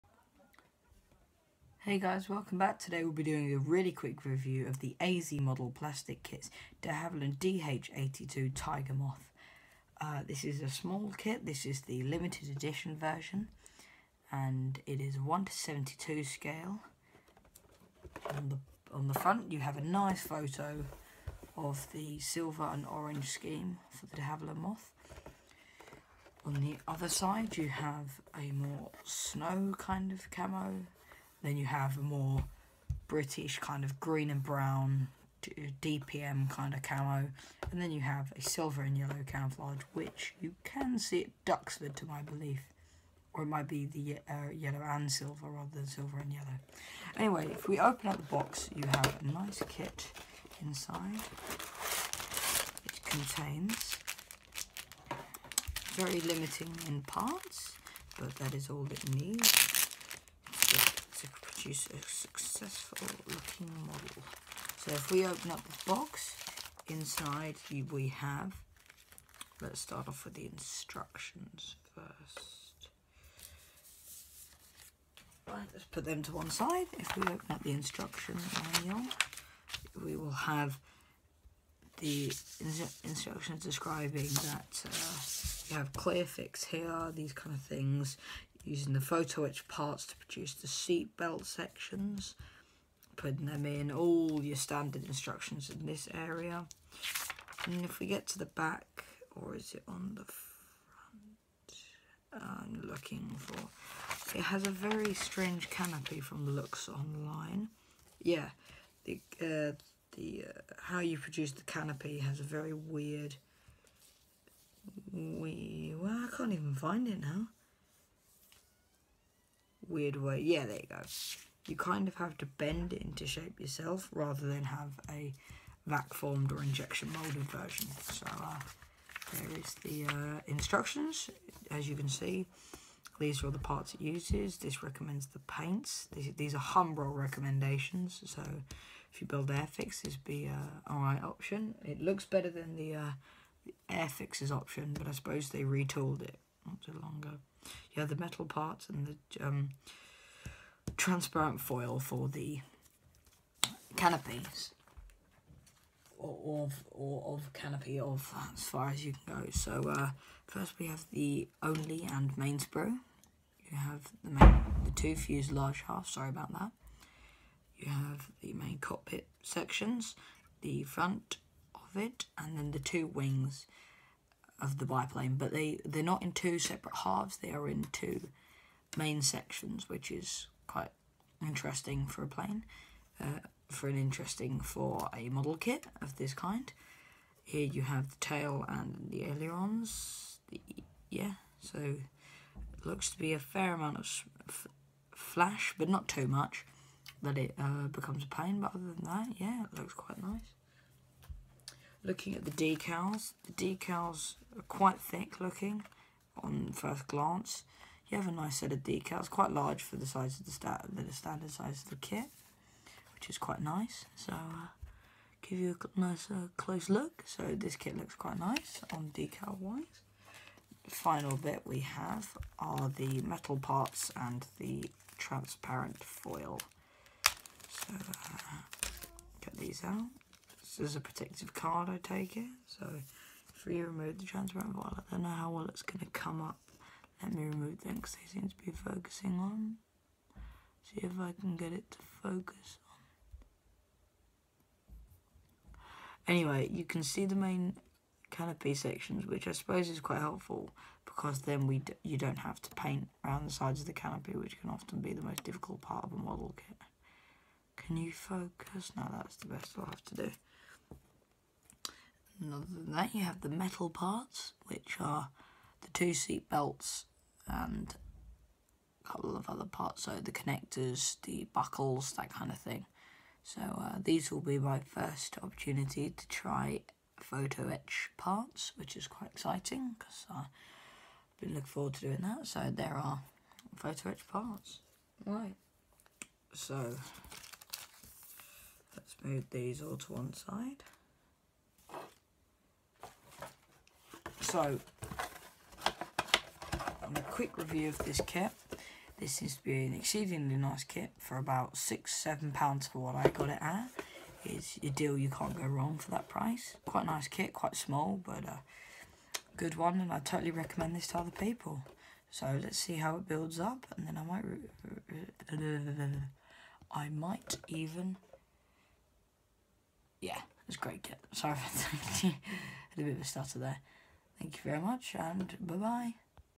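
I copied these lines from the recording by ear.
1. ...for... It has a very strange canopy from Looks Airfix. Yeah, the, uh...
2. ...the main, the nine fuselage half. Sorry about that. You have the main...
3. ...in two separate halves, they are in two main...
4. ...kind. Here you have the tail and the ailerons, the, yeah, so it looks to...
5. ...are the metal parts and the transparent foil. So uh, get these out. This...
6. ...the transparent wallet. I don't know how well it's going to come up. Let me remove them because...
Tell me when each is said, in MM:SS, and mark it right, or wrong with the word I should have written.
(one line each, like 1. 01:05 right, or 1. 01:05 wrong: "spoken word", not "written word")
1. 01:43 wrong: "Online", not "Airfix"
2. 02:44 wrong: "two", not "nine"
3. 02:56 right
4. 03:06 right
5. 03:42 right
6. 03:54 right.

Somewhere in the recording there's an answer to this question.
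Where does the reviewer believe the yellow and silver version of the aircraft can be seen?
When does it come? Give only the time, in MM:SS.
00:41.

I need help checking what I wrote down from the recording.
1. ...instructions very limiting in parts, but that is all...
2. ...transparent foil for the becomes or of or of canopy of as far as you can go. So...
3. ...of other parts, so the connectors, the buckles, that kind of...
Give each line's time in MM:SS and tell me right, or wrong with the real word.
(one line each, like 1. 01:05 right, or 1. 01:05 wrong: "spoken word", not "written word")
1. 00:53 wrong: "contains", not "instructions"
2. 02:30 wrong: "canopies", not "becomes"
3. 04:29 right.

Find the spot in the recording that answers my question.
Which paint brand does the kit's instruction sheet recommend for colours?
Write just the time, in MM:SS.
02:16.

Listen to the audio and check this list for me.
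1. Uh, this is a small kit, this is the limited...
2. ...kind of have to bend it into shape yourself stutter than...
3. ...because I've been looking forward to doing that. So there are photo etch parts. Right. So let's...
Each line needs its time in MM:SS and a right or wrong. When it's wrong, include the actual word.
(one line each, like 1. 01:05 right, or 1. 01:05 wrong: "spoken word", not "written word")
1. 00:09 right
2. 02:01 wrong: "rather", not "stutter"
3. 04:39 right.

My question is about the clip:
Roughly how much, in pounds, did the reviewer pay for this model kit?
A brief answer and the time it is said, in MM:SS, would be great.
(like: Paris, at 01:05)
6 or 7 pounds, at 05:01.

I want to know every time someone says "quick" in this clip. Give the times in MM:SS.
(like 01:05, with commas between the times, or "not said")
00:03, 04:57.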